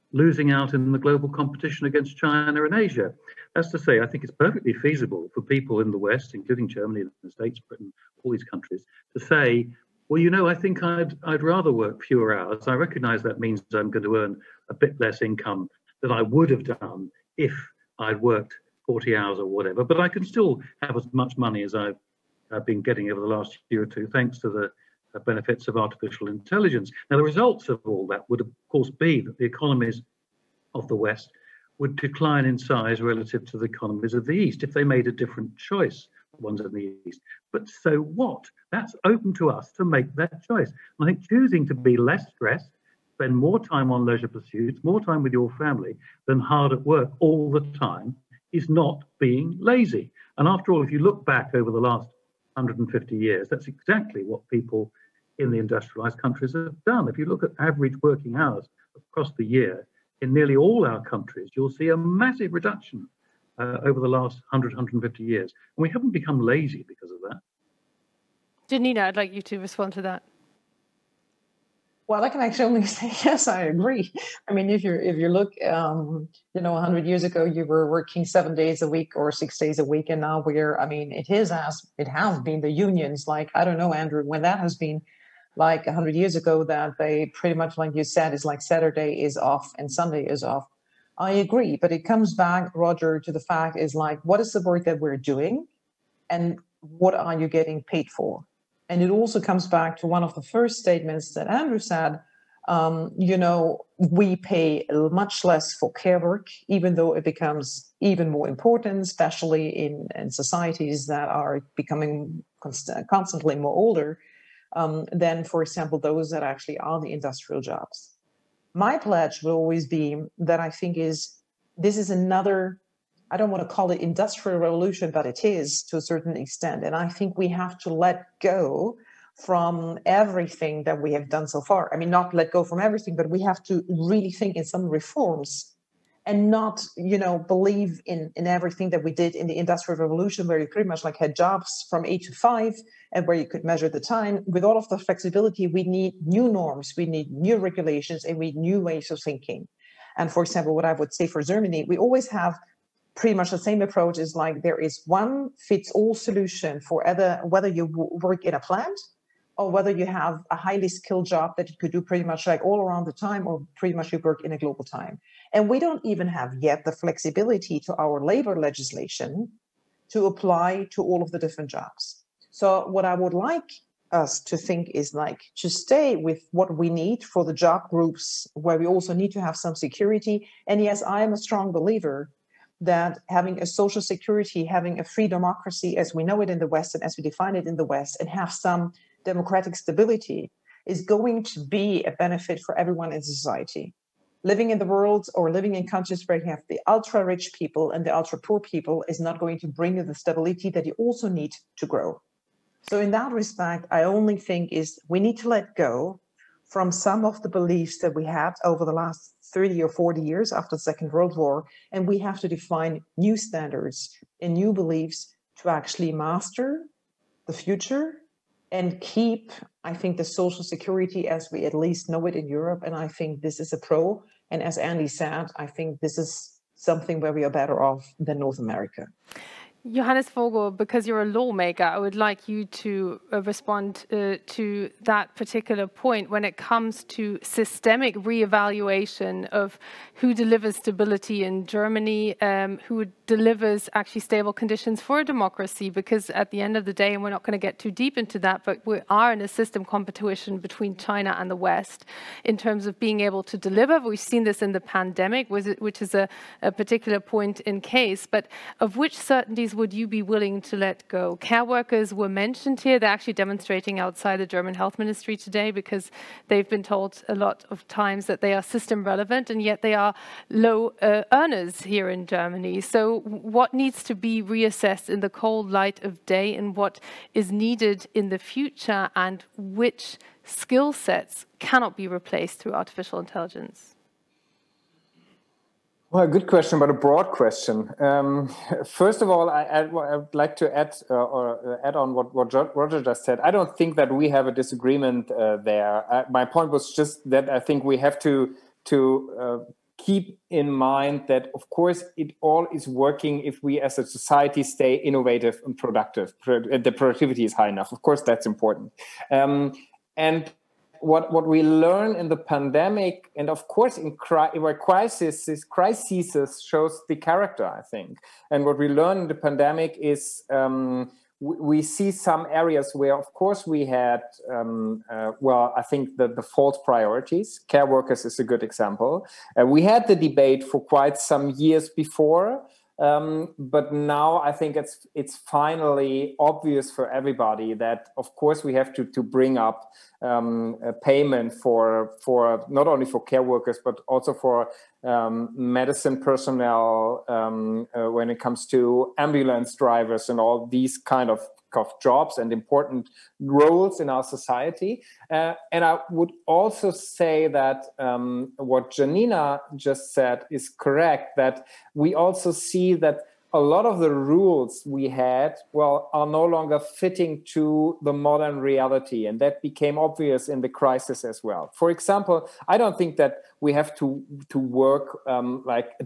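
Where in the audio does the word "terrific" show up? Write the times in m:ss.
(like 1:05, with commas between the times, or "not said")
not said.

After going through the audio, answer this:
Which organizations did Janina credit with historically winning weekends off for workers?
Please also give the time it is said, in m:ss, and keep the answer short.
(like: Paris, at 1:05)
The unions, at 1:22.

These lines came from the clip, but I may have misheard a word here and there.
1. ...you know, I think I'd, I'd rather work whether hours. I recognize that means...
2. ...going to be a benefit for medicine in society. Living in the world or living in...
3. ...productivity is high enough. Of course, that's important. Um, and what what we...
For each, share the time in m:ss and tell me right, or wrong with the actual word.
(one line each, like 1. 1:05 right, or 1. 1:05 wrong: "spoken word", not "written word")
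1. 0:10 wrong: "fewer", not "whether"
2. 3:11 wrong: "everyone", not "medicine"
3. 5:06 right.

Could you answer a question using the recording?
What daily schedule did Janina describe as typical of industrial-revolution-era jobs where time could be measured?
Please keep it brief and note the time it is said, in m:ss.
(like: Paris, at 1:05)
8 to 5, at 2:22.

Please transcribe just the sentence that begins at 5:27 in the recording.
Care workers is a good example.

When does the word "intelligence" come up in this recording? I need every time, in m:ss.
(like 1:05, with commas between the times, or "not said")
0:26, 4:43.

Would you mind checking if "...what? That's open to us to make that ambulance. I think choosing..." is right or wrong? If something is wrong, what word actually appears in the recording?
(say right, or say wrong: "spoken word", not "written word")
wrong: "choice", not "ambulance".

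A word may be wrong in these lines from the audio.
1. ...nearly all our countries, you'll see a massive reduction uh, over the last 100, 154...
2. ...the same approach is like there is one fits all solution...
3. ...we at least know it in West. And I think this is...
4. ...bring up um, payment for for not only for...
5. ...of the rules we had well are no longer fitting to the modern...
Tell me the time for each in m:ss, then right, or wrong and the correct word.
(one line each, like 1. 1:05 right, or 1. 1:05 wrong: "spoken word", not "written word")
1. 1:00 wrong: "150", not "154"
2. 2:33 right
3. 3:41 wrong: "Europe", not "West"
4. 5:39 right
5. 6:03 right.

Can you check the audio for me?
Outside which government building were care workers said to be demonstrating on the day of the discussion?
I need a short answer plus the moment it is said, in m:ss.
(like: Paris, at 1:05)
German health ministry, at 4:24.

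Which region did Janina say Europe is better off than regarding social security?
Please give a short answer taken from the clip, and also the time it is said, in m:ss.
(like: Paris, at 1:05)
North America, at 3:48.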